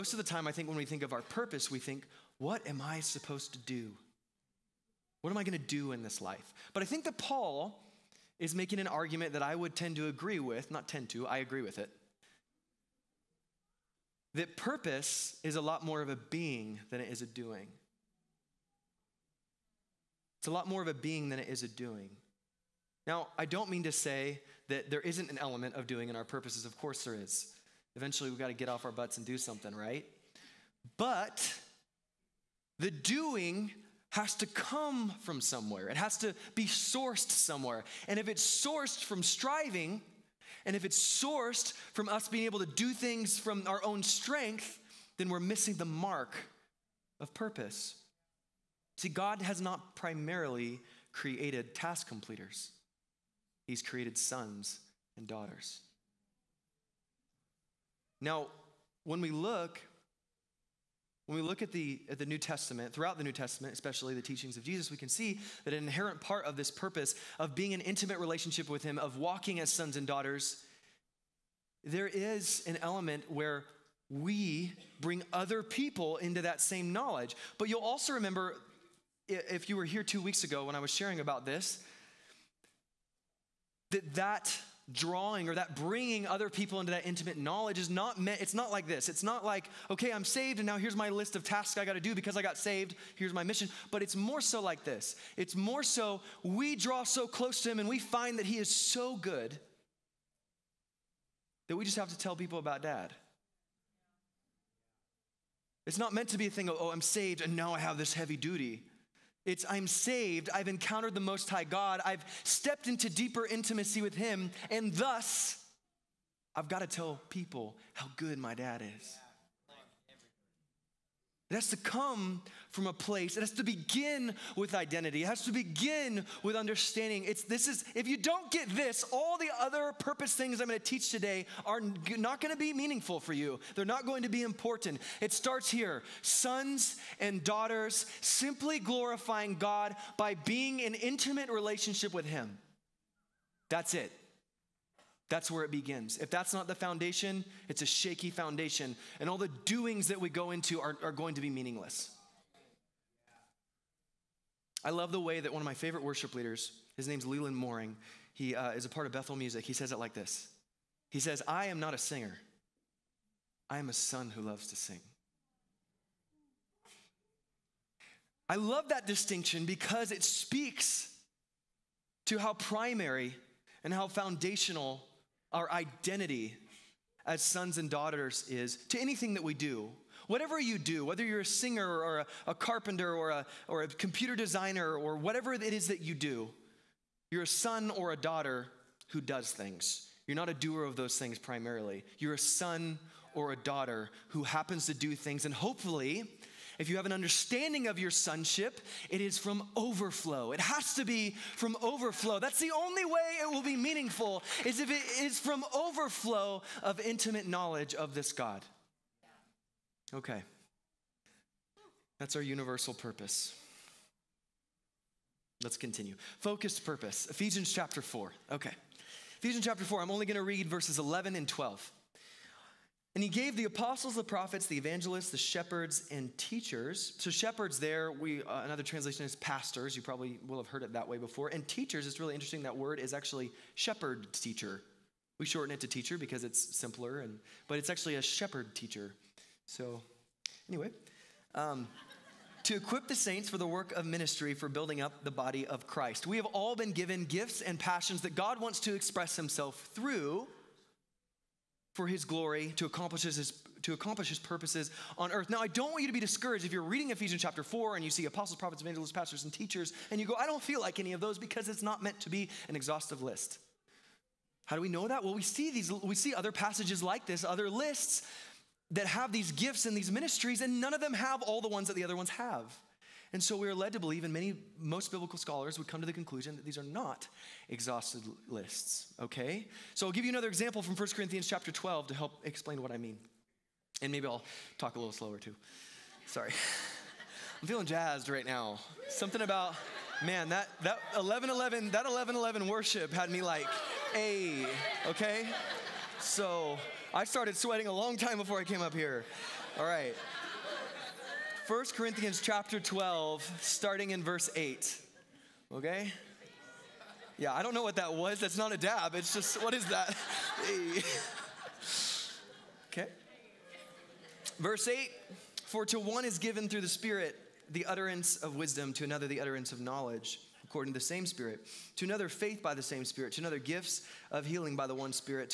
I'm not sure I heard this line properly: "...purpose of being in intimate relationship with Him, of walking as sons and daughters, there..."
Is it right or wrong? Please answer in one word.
right.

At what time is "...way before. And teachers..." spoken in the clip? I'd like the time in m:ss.
3:51.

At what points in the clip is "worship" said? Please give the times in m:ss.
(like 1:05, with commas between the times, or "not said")
2:36, 4:52.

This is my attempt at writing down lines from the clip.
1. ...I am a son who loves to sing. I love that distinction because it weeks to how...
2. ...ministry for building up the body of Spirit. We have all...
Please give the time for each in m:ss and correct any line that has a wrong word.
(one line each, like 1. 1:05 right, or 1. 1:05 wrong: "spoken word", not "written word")
1. 2:43 wrong: "speaks", not "weeks"
2. 4:04 wrong: "Christ", not "Spirit".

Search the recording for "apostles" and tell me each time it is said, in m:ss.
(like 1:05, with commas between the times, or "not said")
3:43, 4:18.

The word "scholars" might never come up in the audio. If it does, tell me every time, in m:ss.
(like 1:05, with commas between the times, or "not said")
4:35.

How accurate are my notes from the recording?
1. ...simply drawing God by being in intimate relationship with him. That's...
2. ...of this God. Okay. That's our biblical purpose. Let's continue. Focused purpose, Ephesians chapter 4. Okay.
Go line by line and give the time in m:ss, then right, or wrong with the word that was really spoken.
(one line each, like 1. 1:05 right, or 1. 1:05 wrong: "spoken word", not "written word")
1. 2:18 wrong: "glorifying", not "drawing"
2. 3:27 wrong: "universal", not "biblical".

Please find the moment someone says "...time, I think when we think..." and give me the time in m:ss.
0:00.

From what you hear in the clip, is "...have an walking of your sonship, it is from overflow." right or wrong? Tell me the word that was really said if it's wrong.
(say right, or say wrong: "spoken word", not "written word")
wrong: "understanding", not "walking".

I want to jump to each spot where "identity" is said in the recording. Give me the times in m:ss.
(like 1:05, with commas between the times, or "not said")
2:04, 2:55.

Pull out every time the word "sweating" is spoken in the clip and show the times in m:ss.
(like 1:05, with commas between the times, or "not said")
4:57.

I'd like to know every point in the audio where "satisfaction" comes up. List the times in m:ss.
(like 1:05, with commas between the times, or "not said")
not said.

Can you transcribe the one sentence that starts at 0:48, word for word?
See, God has not primarily created task completers, He's created sons and daughters.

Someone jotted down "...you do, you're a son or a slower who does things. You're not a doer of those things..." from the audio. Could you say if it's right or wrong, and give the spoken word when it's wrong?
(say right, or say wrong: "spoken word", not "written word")
wrong: "daughter", not "slower".